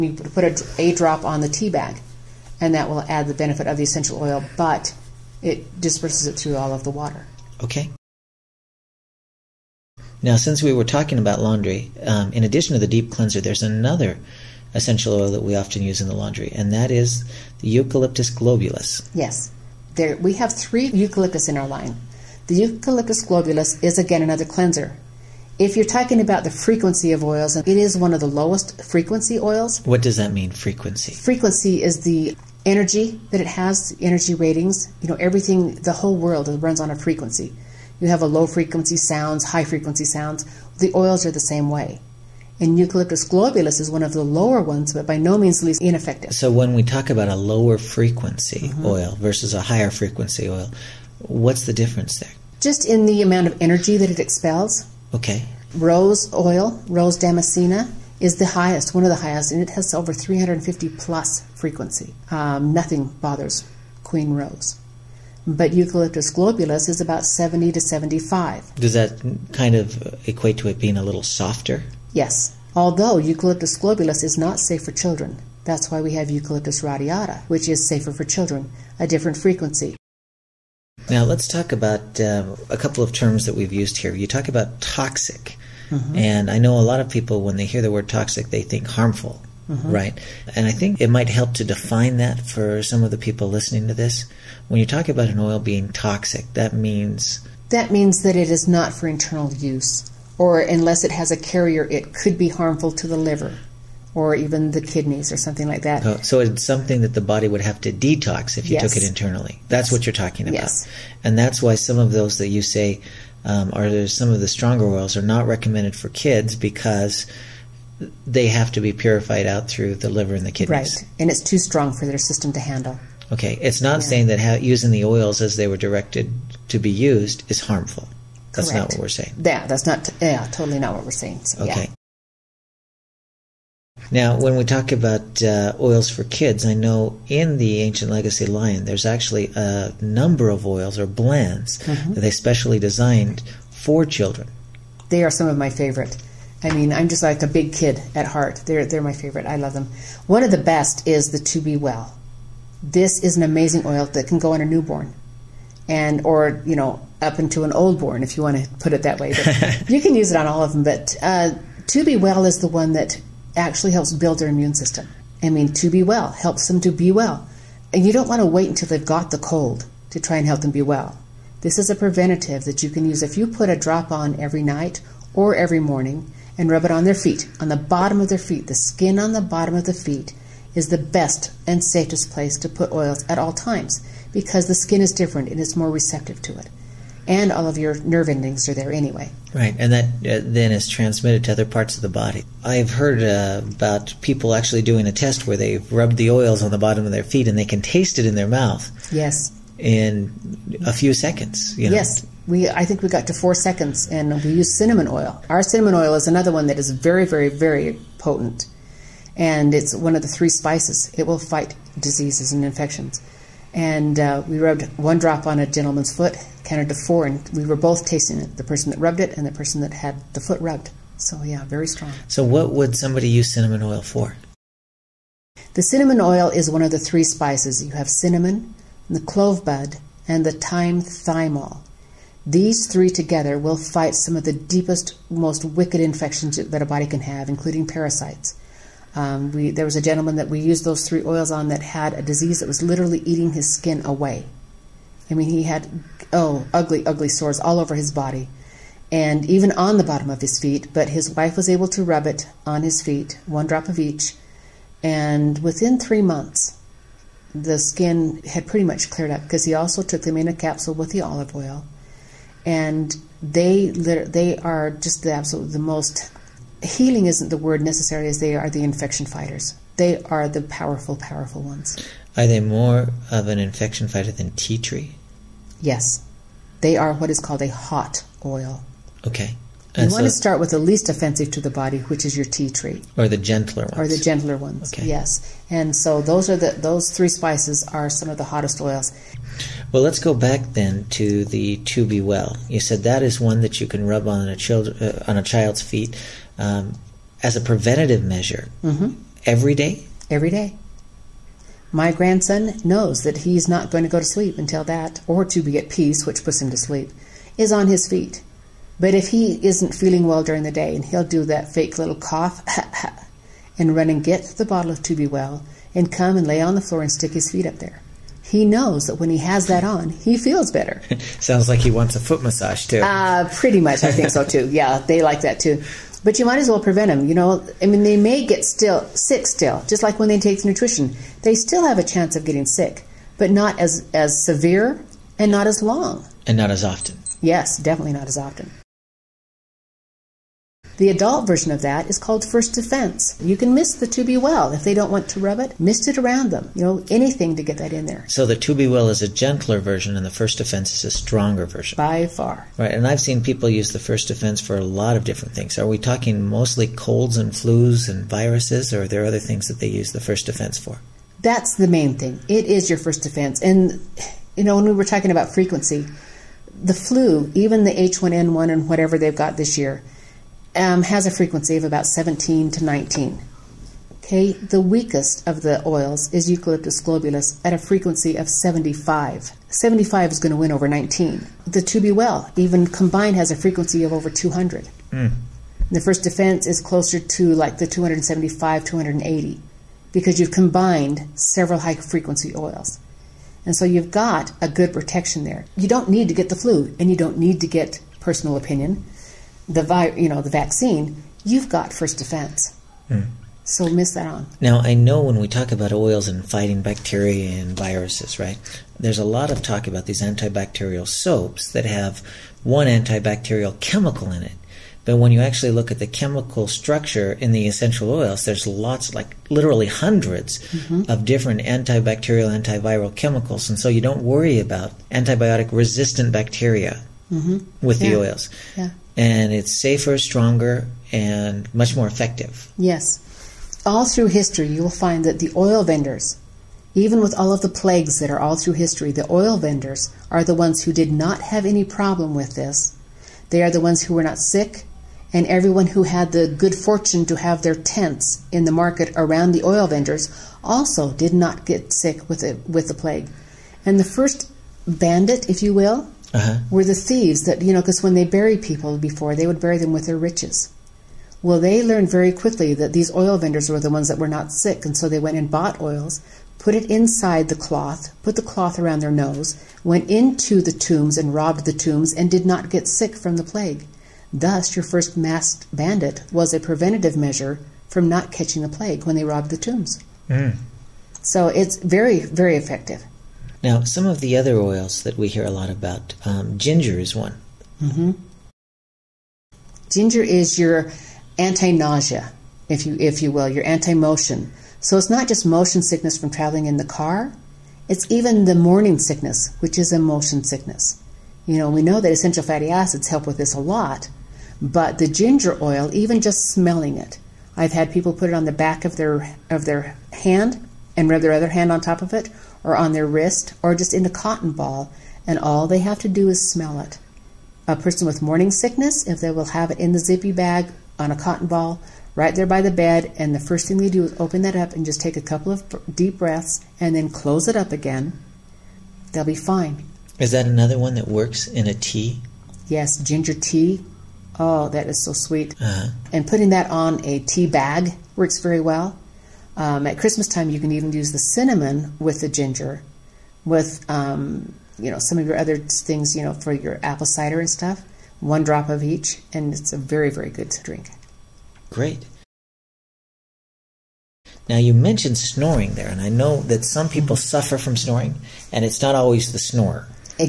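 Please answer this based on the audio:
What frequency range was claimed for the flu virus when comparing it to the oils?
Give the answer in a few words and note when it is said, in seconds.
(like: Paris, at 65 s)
17 to 19, at 372 s.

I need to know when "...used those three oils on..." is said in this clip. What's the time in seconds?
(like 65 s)
240 s.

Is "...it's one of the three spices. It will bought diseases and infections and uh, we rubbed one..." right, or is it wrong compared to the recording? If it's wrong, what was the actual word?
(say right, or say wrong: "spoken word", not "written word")
wrong: "fight", not "bought".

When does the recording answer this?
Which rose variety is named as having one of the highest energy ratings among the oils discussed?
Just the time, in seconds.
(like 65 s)
56 s.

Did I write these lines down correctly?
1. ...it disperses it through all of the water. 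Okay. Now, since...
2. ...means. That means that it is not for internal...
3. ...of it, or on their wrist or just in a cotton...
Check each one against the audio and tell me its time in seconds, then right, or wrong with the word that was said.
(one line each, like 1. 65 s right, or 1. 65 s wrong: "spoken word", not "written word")
1. 5 s right
2. 96 s right
3. 512 s right.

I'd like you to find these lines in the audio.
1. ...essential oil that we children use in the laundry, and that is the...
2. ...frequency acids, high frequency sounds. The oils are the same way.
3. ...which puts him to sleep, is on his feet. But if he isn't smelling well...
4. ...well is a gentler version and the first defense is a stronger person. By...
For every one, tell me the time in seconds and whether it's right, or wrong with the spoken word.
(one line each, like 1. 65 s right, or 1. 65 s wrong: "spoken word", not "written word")
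1. 14 s wrong: "often", not "children"
2. 38 s wrong: "sounds", not "acids"
3. 306 s wrong: "feeling", not "smelling"
4. 348 s wrong: "version", not "person".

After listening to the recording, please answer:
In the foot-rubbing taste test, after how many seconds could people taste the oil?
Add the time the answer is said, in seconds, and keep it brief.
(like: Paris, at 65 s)
4 seconds, at 203 s.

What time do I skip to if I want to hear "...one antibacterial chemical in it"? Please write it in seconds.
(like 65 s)
412 s.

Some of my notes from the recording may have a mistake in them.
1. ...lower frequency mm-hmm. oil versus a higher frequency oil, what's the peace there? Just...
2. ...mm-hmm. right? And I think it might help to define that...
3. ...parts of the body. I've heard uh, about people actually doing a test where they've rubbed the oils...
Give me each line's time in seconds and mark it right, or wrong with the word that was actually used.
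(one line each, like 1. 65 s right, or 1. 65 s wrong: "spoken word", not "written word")
1. 47 s wrong: "difference", not "peace"
2. 89 s right
3. 191 s right.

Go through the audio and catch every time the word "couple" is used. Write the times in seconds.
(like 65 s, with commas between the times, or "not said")
82 s, 525 s.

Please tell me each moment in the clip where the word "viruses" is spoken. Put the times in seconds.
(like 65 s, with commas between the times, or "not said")
358 s, 407 s.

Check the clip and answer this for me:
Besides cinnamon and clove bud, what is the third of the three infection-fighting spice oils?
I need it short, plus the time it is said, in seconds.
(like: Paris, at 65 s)
Thyme thymol, at 230 s.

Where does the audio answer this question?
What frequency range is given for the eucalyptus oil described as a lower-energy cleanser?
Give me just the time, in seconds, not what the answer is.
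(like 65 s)
67 s.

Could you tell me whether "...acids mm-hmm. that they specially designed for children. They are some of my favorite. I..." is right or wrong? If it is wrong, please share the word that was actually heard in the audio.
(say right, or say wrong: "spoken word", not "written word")
wrong: "blends", not "acids".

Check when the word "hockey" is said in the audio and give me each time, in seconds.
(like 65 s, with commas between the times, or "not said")
not said.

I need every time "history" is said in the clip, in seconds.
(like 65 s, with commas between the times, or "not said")
434 s, 438 s.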